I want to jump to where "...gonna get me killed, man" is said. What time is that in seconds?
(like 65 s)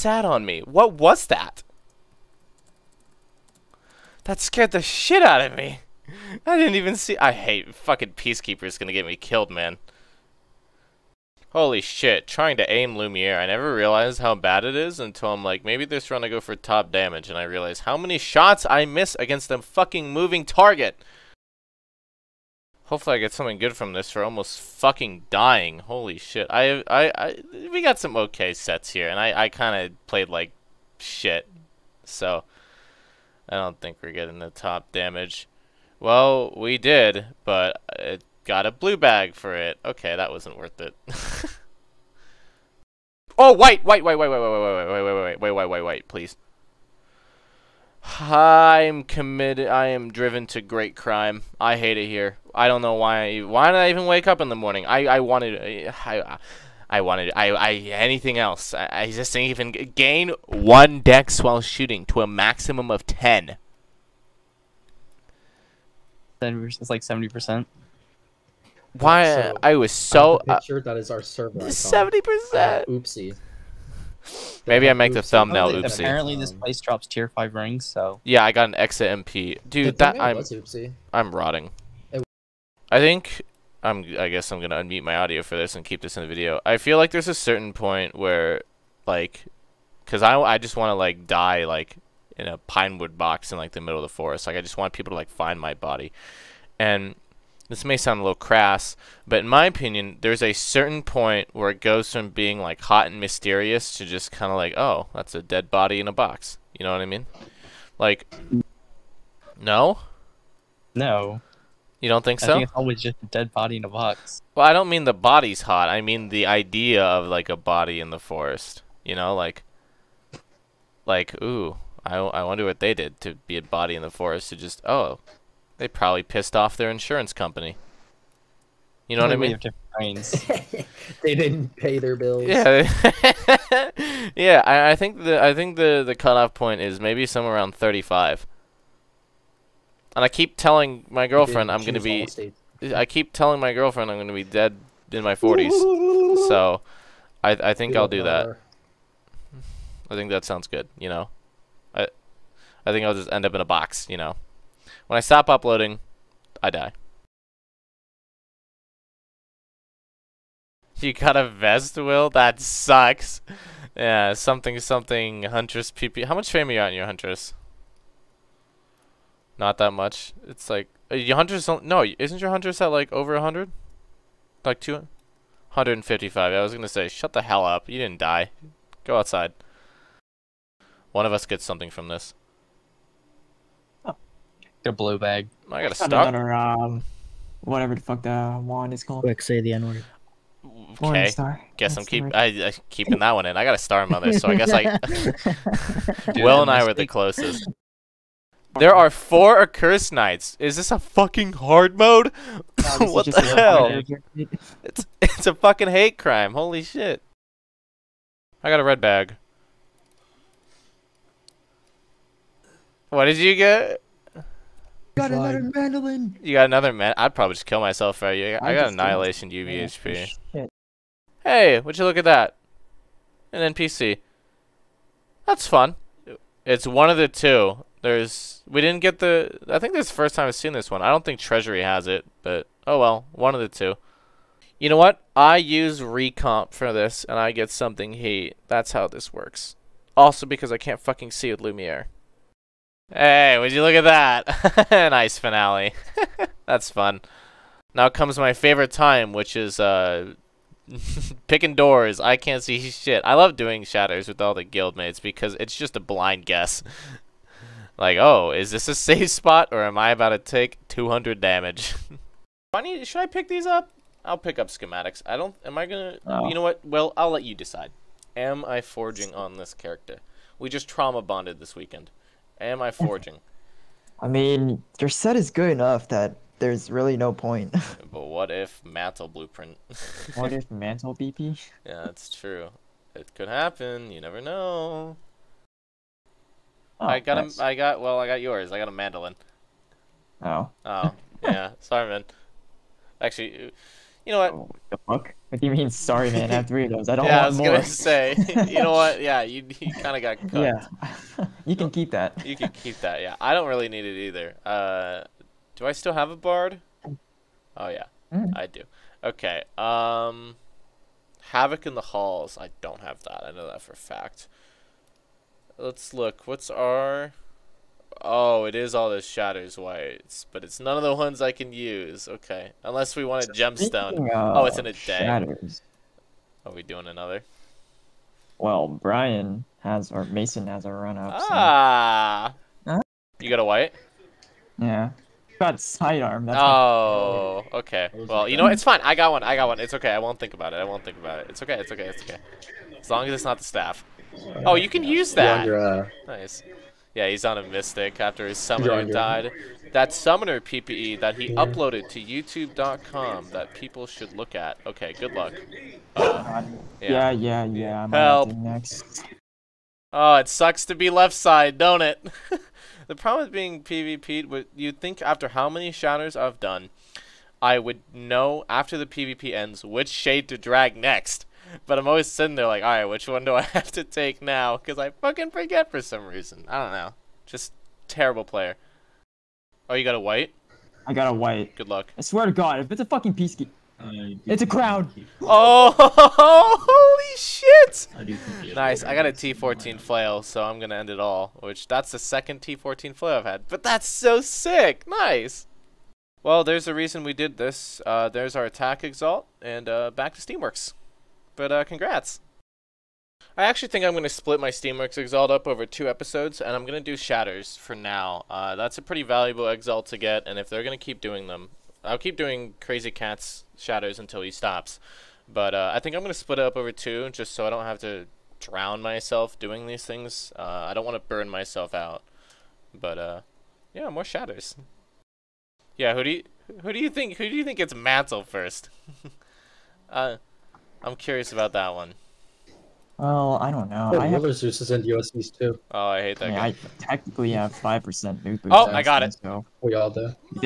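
8 s.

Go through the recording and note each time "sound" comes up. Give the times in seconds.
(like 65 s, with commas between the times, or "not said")
97 s, 150 s.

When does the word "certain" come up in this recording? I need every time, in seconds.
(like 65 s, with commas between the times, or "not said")
87 s, 100 s.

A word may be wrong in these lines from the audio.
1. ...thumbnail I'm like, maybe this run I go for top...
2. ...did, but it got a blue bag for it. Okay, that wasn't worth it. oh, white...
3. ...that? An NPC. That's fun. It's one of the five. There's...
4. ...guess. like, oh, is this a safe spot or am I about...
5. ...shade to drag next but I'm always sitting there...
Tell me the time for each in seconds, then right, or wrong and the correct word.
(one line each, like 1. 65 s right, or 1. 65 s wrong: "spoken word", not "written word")
1. 14 s wrong: "until", not "thumbnail"
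2. 36 s right
3. 222 s wrong: "two", not "five"
4. 256 s right
5. 370 s right.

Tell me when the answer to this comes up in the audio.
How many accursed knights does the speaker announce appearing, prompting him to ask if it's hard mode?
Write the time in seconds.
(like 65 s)
199 s.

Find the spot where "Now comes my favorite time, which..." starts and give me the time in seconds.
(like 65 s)
247 s.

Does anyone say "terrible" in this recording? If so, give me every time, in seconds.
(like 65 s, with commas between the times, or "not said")
378 s.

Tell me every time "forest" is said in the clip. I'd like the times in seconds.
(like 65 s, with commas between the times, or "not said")
94 s, 118 s, 124 s.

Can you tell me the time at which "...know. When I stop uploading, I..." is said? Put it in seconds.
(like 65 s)
154 s.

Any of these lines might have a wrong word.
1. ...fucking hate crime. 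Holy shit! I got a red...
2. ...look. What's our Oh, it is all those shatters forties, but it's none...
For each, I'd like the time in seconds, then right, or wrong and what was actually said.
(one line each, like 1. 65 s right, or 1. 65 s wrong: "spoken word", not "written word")
1. 205 s right
2. 316 s wrong: "whites", not "forties".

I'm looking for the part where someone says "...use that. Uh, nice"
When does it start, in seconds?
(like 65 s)
345 s.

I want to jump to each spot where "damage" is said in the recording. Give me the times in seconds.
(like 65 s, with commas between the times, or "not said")
16 s, 34 s, 261 s.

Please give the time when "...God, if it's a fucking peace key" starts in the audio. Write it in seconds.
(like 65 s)
382 s.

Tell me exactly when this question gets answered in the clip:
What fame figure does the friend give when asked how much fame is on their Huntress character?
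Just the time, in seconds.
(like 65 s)
174 s.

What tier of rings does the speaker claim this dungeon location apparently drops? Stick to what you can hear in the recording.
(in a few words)
tier 5.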